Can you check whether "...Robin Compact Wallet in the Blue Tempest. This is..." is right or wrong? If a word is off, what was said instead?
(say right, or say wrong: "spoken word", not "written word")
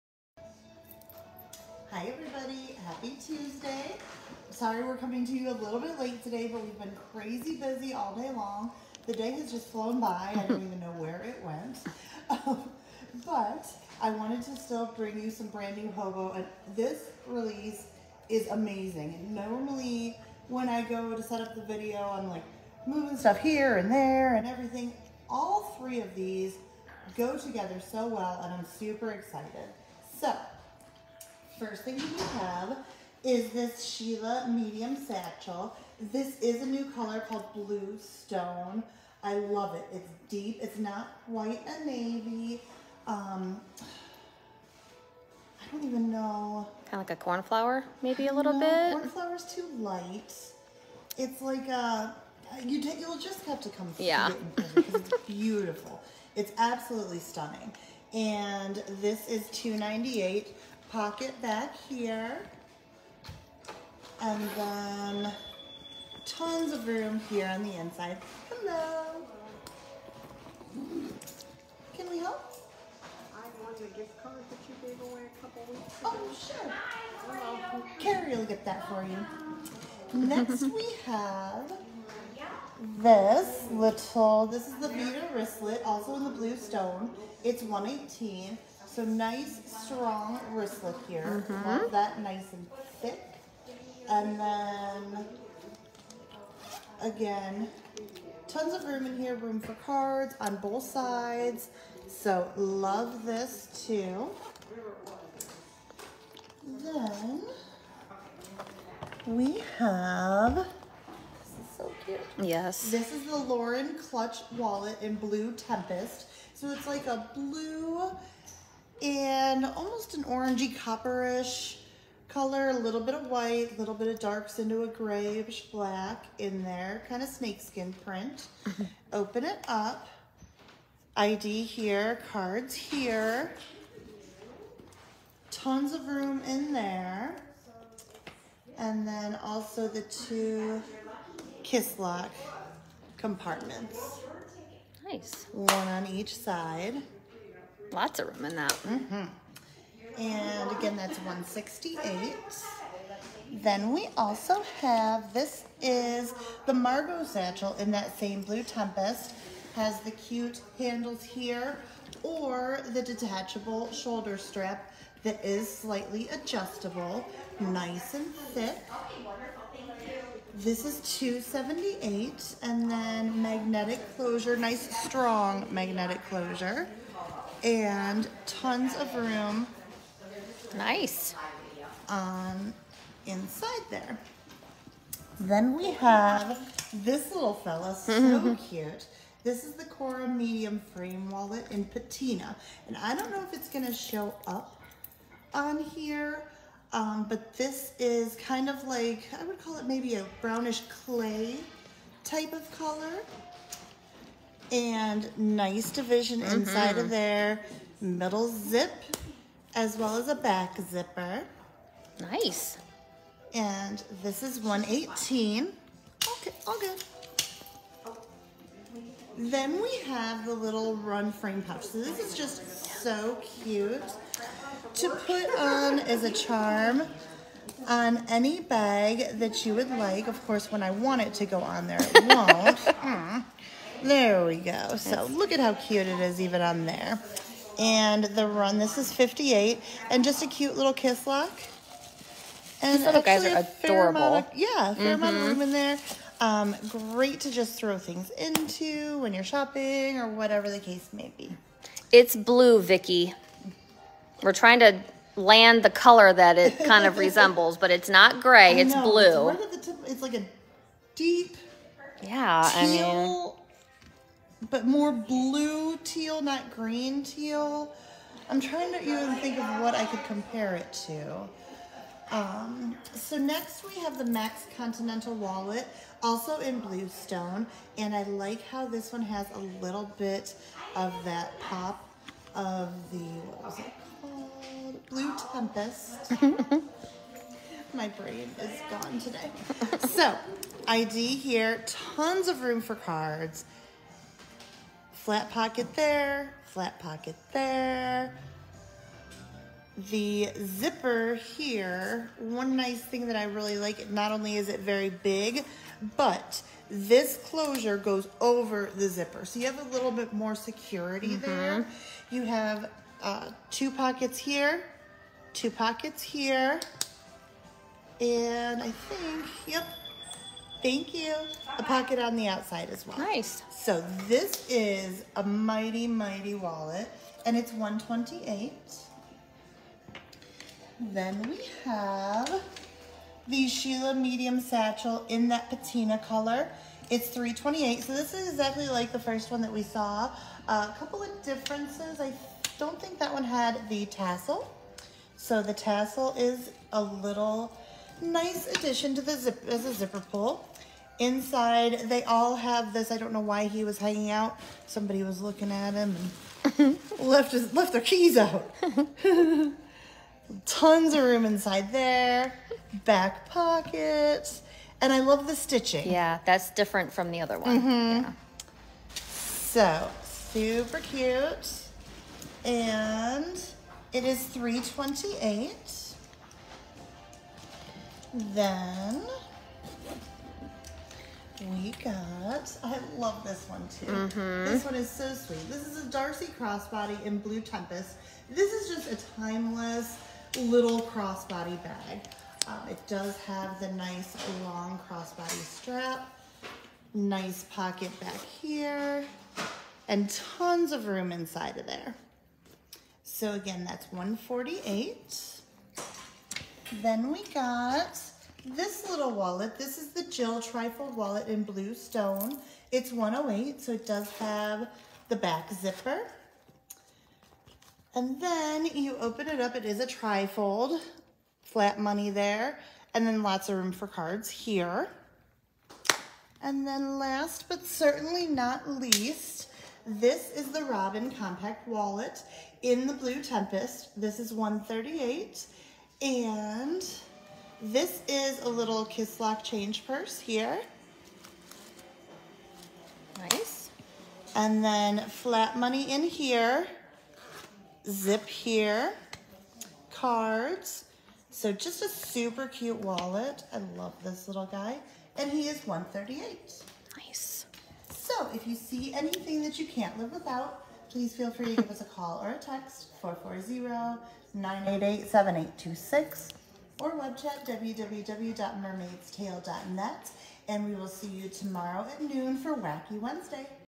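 right.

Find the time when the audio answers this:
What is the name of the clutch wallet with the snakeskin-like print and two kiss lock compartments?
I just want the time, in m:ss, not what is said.
1:53.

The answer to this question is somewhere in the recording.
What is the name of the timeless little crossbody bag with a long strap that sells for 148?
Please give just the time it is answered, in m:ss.
6:26.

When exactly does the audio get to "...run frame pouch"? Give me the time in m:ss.
3:40.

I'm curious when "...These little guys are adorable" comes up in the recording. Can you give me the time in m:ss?
4:02.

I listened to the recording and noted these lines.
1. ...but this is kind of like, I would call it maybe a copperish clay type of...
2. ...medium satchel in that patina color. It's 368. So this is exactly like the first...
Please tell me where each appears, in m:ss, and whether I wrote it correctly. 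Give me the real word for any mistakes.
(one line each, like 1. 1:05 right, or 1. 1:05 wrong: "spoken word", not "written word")
1. 3:17 wrong: "brownish", not "copperish"
2. 5:34 wrong: "328", not "368".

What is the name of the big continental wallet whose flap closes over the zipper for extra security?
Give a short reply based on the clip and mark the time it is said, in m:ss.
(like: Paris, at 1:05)
Max, at 4:34.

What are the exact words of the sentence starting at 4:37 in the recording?
And I like how this one has a little bit of that pop of the, what was it called?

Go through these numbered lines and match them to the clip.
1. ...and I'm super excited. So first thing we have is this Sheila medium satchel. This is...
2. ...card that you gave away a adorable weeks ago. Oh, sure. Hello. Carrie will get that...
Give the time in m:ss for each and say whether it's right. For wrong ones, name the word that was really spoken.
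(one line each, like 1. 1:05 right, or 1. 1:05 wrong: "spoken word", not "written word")
1. 0:28 right
2. 1:14 wrong: "couple", not "adorable".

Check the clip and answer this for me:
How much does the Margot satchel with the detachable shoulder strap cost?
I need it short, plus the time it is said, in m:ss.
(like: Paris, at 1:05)
278, at 2:50.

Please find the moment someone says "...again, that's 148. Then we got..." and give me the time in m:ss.
6:43.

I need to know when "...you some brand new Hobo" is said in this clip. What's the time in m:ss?
0:15.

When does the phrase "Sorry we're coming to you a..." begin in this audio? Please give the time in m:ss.
0:04.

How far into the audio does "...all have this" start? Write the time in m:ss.
5:52.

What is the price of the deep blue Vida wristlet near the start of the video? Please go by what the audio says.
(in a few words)
118.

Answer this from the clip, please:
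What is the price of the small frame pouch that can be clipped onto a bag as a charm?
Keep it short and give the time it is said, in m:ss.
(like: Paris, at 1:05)
58, at 3:58.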